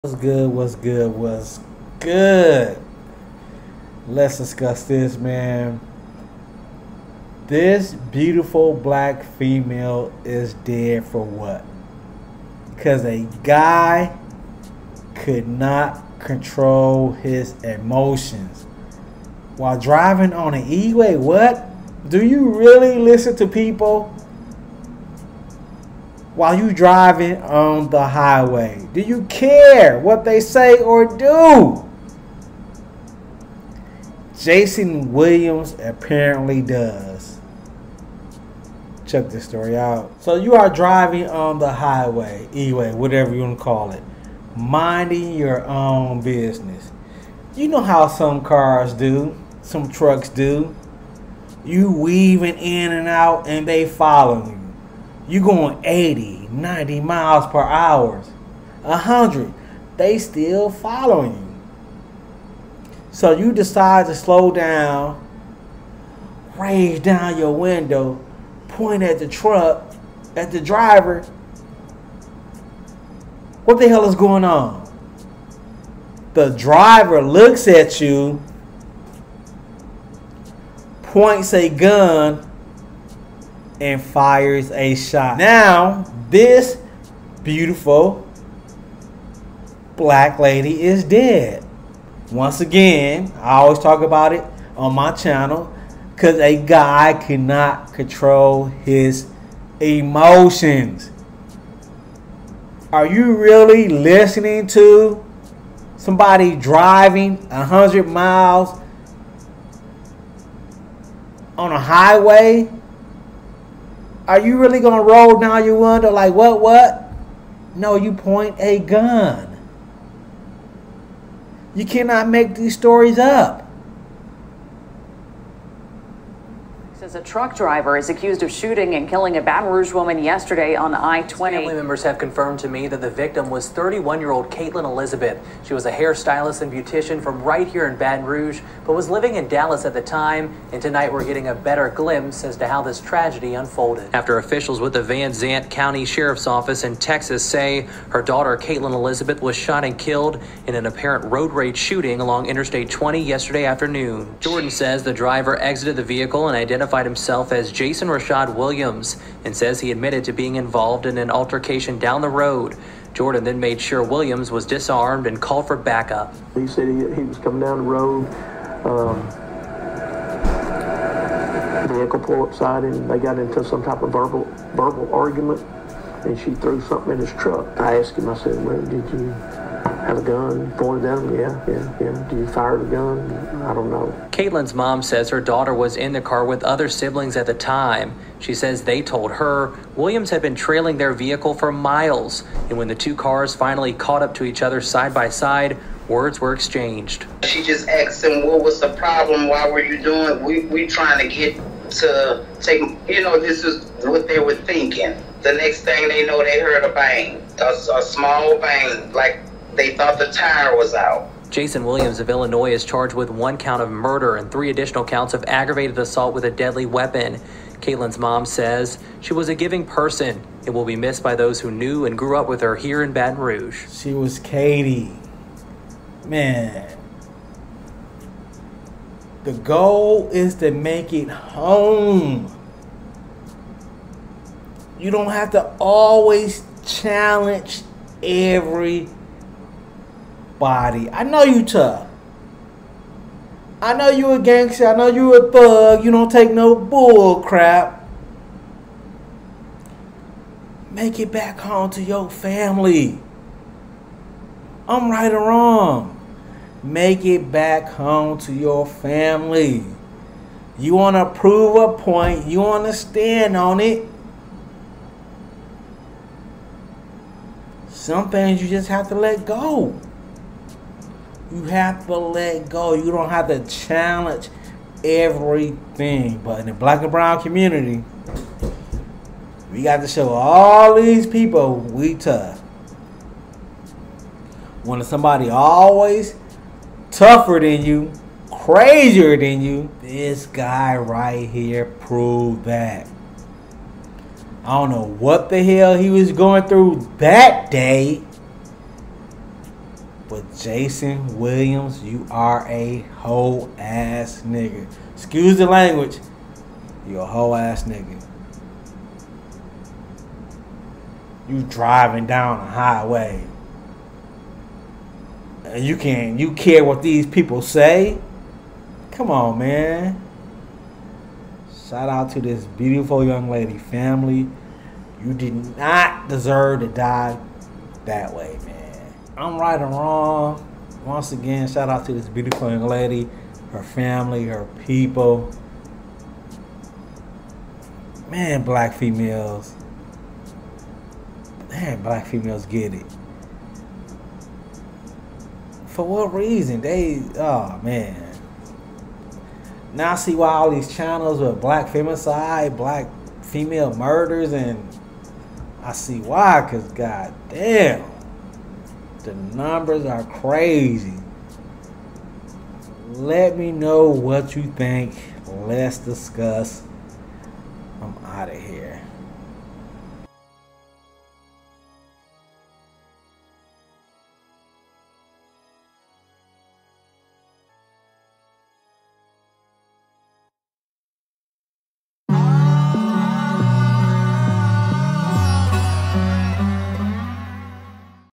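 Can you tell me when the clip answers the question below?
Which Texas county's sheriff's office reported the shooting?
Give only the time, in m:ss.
2:25.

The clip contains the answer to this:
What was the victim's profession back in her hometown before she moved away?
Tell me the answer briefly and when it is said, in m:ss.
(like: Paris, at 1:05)
Hairstylist and beautician, at 2:15.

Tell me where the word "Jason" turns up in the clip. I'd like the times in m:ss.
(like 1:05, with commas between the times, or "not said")
0:34, 2:37, 3:31, 5:00.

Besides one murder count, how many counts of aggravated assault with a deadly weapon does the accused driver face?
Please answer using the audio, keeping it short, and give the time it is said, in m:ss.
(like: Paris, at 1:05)
3, at 3:34.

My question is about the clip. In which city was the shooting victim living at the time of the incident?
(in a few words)
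Dallas.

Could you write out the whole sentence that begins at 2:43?
Jordan then made sure Williams was disarmed and called for backup.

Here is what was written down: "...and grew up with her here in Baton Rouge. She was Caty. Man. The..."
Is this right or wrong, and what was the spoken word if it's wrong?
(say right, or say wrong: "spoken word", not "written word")
right.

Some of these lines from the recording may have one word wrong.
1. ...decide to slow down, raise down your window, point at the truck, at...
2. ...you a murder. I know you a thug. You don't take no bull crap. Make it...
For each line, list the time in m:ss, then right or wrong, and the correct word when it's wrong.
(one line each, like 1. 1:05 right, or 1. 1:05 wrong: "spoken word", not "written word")
1. 1:03 right
2. 4:04 wrong: "gangster", not "murder".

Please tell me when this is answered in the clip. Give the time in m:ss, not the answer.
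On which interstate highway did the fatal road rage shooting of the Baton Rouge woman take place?
2:10.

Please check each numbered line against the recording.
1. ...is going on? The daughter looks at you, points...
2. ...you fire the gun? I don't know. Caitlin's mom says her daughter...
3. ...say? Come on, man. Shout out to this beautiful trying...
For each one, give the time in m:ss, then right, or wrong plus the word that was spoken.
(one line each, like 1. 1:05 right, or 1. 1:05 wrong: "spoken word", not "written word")
1. 1:14 wrong: "driver", not "daughter"
2. 3:02 right
3. 5:17 wrong: "young", not "trying".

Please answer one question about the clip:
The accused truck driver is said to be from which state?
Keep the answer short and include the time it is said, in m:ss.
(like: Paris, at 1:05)
Illinois, at 3:32.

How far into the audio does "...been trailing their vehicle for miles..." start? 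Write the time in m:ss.
3:10.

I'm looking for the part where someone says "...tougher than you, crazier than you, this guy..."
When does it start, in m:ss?
4:47.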